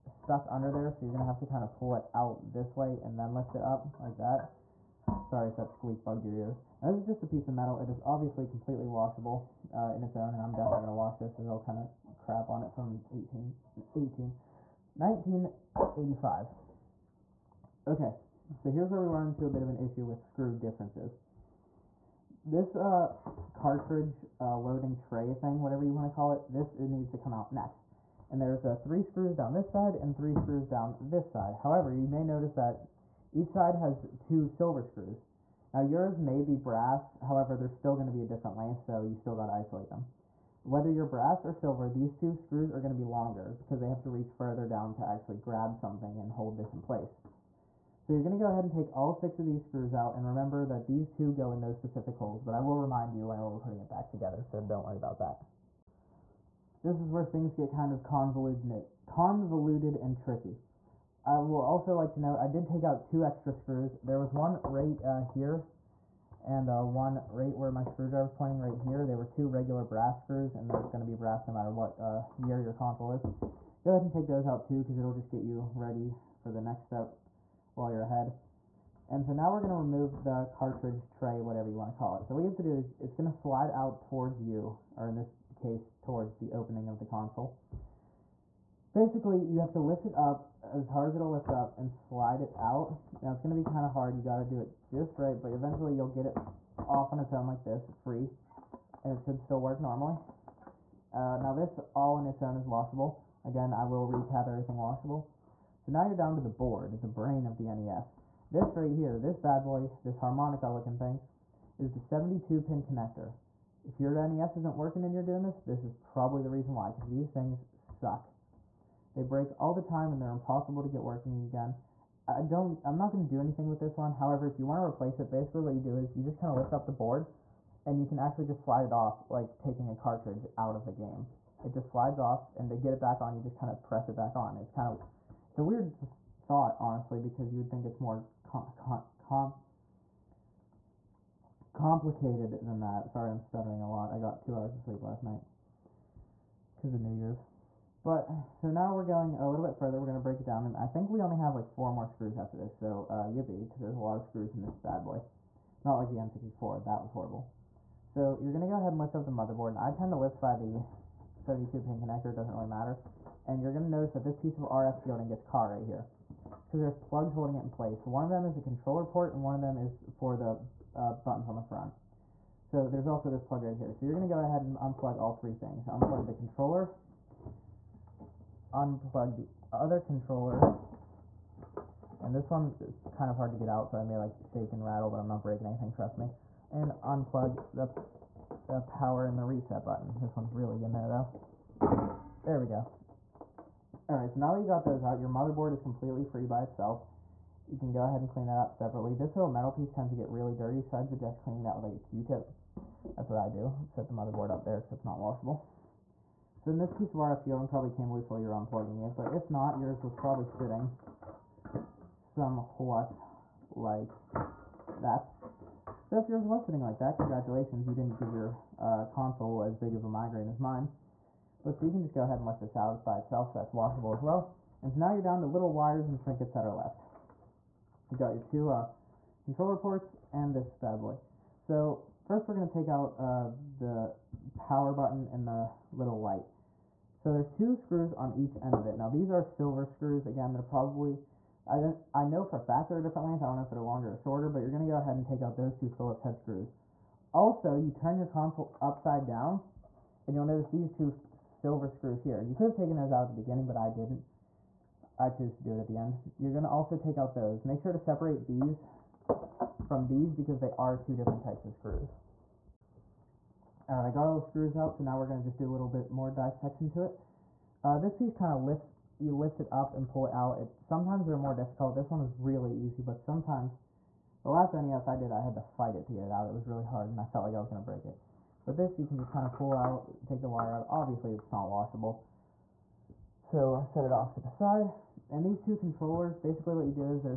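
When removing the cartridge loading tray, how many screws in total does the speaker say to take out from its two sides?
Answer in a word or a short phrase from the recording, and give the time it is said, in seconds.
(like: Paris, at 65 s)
6, at 49 s.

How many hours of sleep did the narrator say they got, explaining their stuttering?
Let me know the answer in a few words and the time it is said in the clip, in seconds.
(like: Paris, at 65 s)
2, at 144 s.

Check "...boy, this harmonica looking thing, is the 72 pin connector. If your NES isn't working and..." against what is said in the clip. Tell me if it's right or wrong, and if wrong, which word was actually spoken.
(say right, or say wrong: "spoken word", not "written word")
right.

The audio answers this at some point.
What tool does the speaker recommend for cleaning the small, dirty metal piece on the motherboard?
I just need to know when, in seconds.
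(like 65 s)
201 s.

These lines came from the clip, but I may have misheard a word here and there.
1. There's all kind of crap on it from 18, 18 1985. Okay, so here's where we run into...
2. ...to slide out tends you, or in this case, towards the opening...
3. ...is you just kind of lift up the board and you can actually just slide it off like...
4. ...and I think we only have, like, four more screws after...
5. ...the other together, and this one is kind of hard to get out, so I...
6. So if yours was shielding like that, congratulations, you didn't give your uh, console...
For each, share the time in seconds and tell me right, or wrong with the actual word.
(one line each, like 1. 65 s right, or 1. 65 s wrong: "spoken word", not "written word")
1. 11 s right
2. 83 s wrong: "towards", not "tends"
3. 125 s right
4. 150 s right
5. 179 s wrong: "controller", not "together"
6. 216 s wrong: "sitting", not "shielding".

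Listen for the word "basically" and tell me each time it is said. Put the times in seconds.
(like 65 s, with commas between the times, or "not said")
88 s, 125 s, 286 s.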